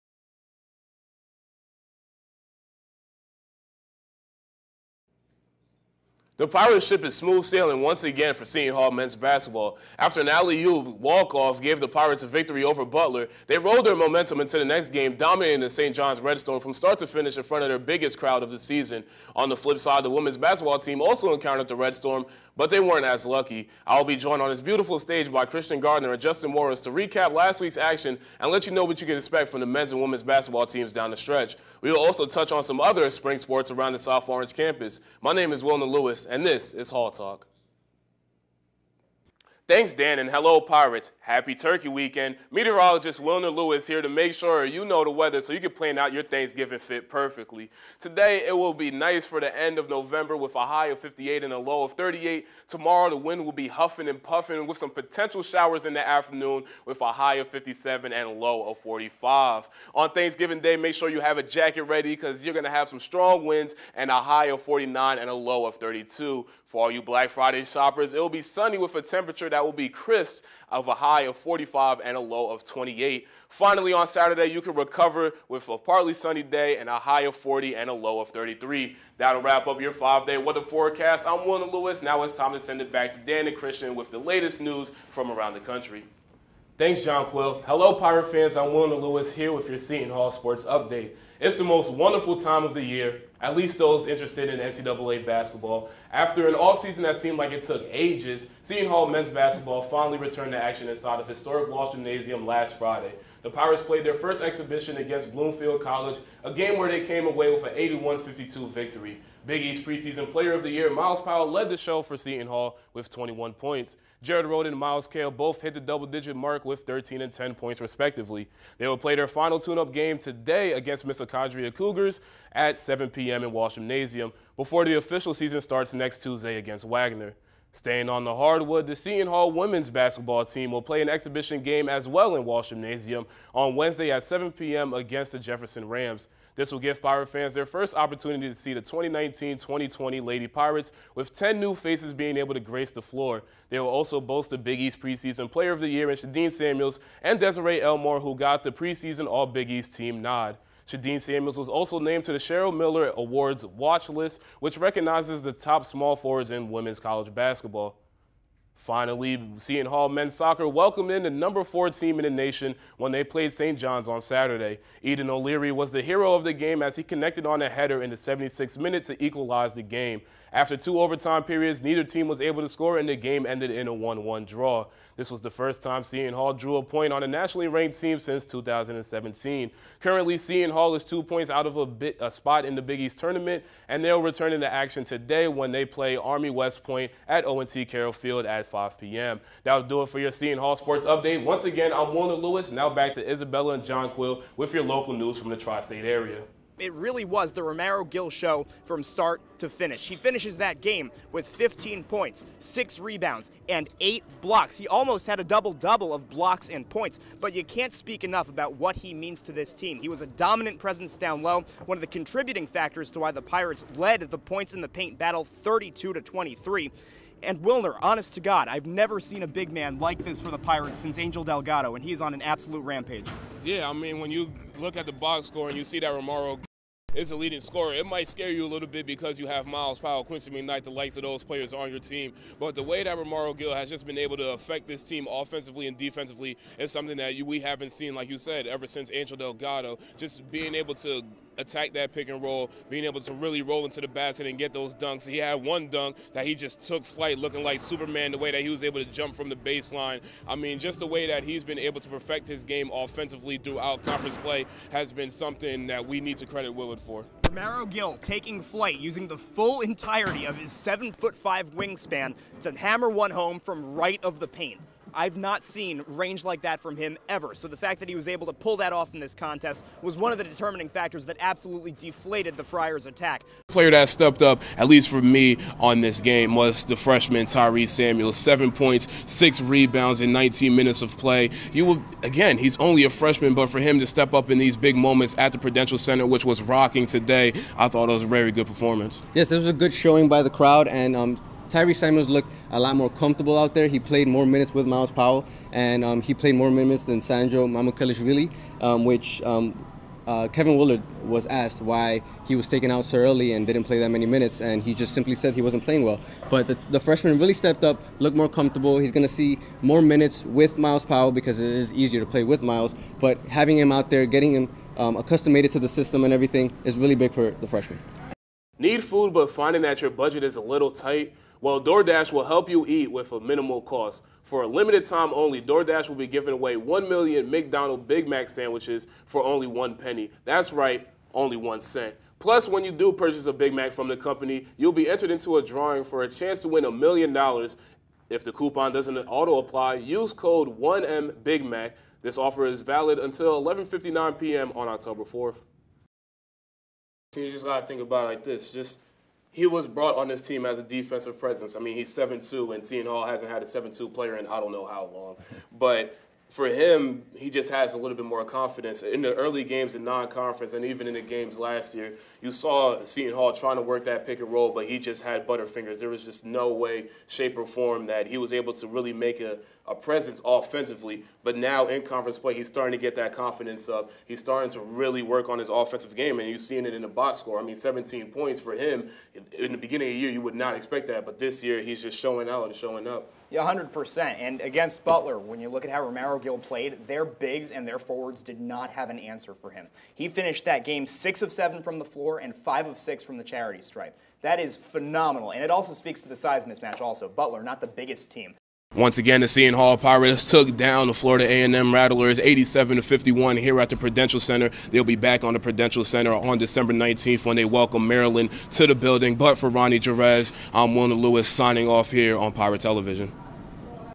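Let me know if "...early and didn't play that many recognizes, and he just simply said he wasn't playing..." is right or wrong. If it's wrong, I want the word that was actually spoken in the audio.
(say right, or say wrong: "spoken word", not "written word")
wrong: "minutes", not "recognizes".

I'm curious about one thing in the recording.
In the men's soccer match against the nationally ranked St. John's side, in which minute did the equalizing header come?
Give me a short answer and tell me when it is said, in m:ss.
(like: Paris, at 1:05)
76th minute, at 2:48.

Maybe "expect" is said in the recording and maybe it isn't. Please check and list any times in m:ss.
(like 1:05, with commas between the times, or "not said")
0:29, 6:20.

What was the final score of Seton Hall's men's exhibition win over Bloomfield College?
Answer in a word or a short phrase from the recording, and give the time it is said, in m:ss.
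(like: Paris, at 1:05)
81-52, at 1:47.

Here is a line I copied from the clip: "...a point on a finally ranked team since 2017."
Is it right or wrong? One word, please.
wrong.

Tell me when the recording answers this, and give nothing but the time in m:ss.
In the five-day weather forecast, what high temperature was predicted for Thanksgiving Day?
1:04.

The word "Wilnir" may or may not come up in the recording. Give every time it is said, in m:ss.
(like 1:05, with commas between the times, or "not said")
0:35, 0:43, 1:28, 3:37, 6:50.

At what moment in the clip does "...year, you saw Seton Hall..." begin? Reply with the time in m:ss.
6:01.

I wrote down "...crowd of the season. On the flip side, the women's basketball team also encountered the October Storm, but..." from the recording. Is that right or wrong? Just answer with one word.
wrong.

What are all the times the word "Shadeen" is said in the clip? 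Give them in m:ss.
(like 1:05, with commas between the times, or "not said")
2:26, 2:30.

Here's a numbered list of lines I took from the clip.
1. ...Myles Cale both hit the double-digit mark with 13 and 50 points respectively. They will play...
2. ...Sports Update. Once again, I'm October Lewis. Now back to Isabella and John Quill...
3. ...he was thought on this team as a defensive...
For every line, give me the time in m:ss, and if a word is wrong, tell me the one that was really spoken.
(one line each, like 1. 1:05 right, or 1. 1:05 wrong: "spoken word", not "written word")
1. 1:54 wrong: "10", not "50"
2. 3:10 wrong: "Warner", not "October"
3. 5:49 wrong: "brought", not "thought".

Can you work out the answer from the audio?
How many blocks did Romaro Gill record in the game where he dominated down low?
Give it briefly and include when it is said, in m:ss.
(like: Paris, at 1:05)
8, at 3:24.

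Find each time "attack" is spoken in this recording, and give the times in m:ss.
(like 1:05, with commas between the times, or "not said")
4:01, 4:33.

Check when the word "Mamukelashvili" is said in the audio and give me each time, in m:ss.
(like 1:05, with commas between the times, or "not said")
4:57.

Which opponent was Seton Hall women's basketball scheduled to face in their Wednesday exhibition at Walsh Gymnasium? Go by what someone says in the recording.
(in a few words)
Jefferson Rams.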